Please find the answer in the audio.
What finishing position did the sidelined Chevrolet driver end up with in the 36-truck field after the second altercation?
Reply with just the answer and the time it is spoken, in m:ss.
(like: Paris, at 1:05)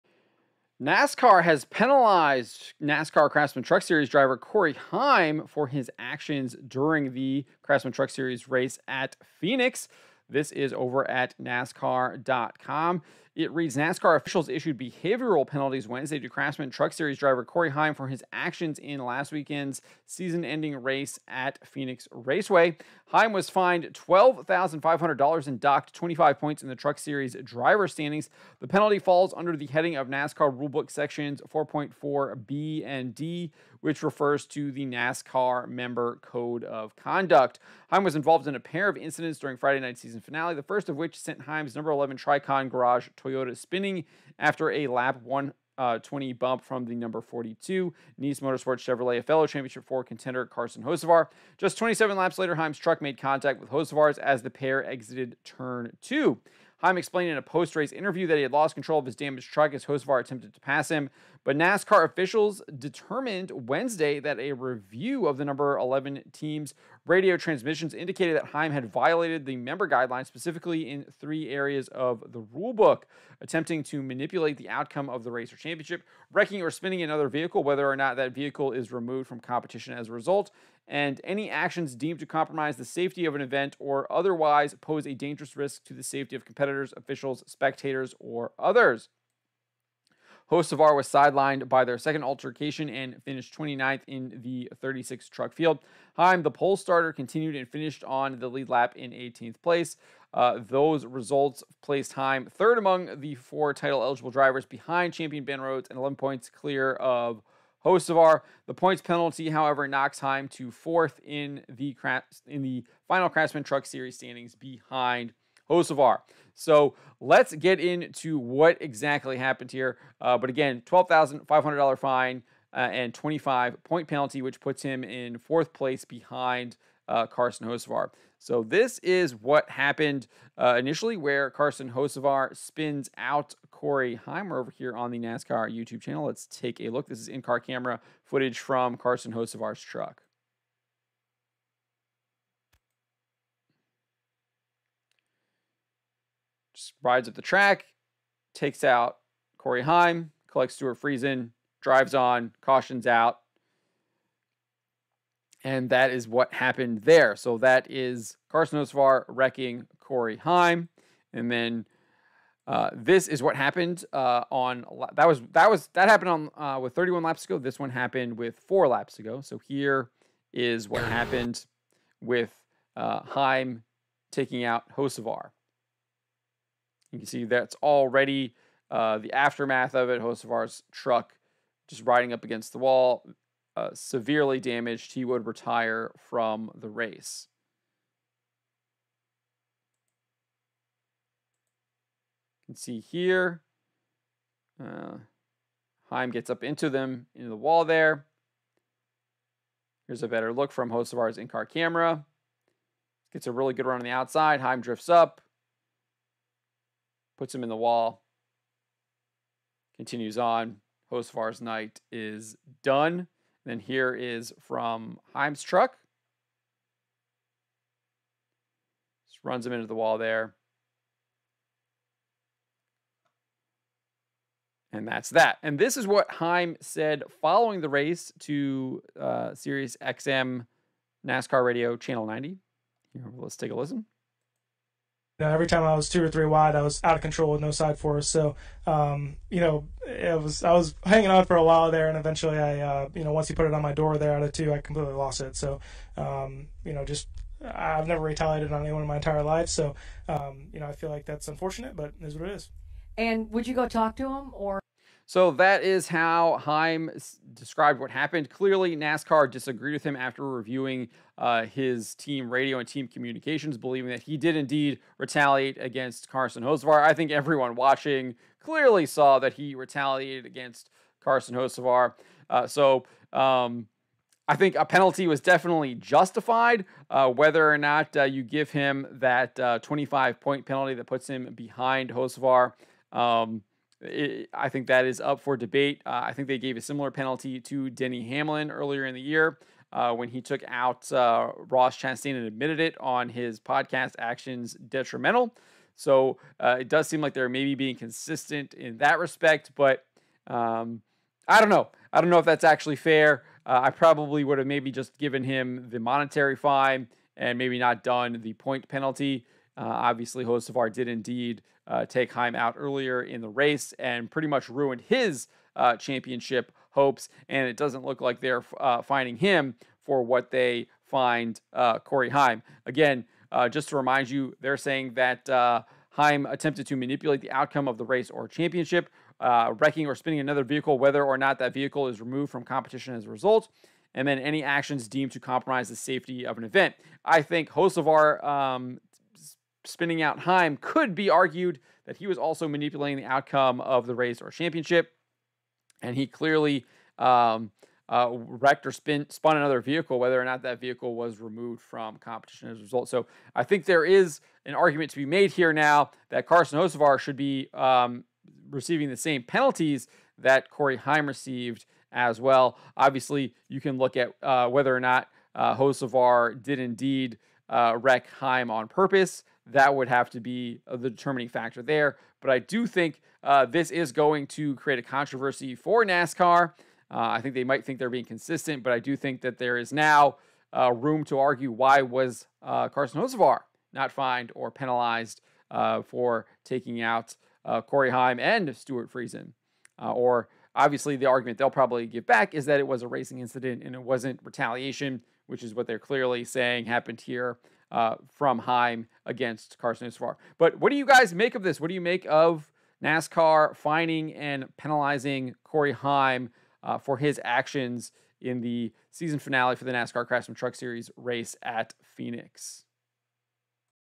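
29th, at 1:33.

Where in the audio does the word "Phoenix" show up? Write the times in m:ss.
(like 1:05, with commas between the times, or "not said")
0:09, 0:21, 6:52.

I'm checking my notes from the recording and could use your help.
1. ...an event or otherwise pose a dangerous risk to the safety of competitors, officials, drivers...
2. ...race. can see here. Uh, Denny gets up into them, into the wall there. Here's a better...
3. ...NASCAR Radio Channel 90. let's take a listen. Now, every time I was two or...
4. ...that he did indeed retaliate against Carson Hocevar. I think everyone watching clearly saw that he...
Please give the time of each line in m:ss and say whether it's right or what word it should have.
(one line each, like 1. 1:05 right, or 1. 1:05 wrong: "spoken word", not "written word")
1. 1:23 wrong: "spectators", not "drivers"
2. 3:06 wrong: "Heim", not "Denny"
3. 3:51 right
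4. 4:24 right.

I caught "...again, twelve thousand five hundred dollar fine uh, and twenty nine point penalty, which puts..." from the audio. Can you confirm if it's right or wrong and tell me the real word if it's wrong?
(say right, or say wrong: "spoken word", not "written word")
wrong: "five", not "nine".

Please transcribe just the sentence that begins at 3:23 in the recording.
Gets a really good run on the outside.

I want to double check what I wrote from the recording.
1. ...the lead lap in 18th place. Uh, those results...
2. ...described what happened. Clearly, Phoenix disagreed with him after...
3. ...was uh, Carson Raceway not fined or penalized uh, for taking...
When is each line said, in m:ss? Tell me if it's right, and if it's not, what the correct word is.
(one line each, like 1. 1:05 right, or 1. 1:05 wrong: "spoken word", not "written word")
1. 1:38 right
2. 4:17 wrong: "NASCAR", not "Phoenix"
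3. 6:22 wrong: "Hocevar", not "Raceway".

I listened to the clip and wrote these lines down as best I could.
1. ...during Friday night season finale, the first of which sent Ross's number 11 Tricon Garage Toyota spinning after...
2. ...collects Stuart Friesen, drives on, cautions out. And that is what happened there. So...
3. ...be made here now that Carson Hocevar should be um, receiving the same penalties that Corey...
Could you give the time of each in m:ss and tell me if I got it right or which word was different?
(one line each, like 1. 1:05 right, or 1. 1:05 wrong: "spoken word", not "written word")
1. 0:39 wrong: "Heim", not "Ross"
2. 2:30 right
3. 5:55 right.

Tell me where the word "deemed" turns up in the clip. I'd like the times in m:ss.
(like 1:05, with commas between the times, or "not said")
1:21, 5:35.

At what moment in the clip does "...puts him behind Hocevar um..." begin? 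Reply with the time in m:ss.
4:41.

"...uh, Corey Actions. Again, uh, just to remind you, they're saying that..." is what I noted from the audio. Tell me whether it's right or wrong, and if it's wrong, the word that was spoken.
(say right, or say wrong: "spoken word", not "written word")
wrong: "Heim", not "Actions".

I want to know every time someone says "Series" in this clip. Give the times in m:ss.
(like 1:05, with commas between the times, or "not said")
0:03, 0:08, 0:16, 0:26, 1:53, 6:50.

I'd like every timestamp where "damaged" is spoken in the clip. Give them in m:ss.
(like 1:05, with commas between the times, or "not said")
0:59, 3:04.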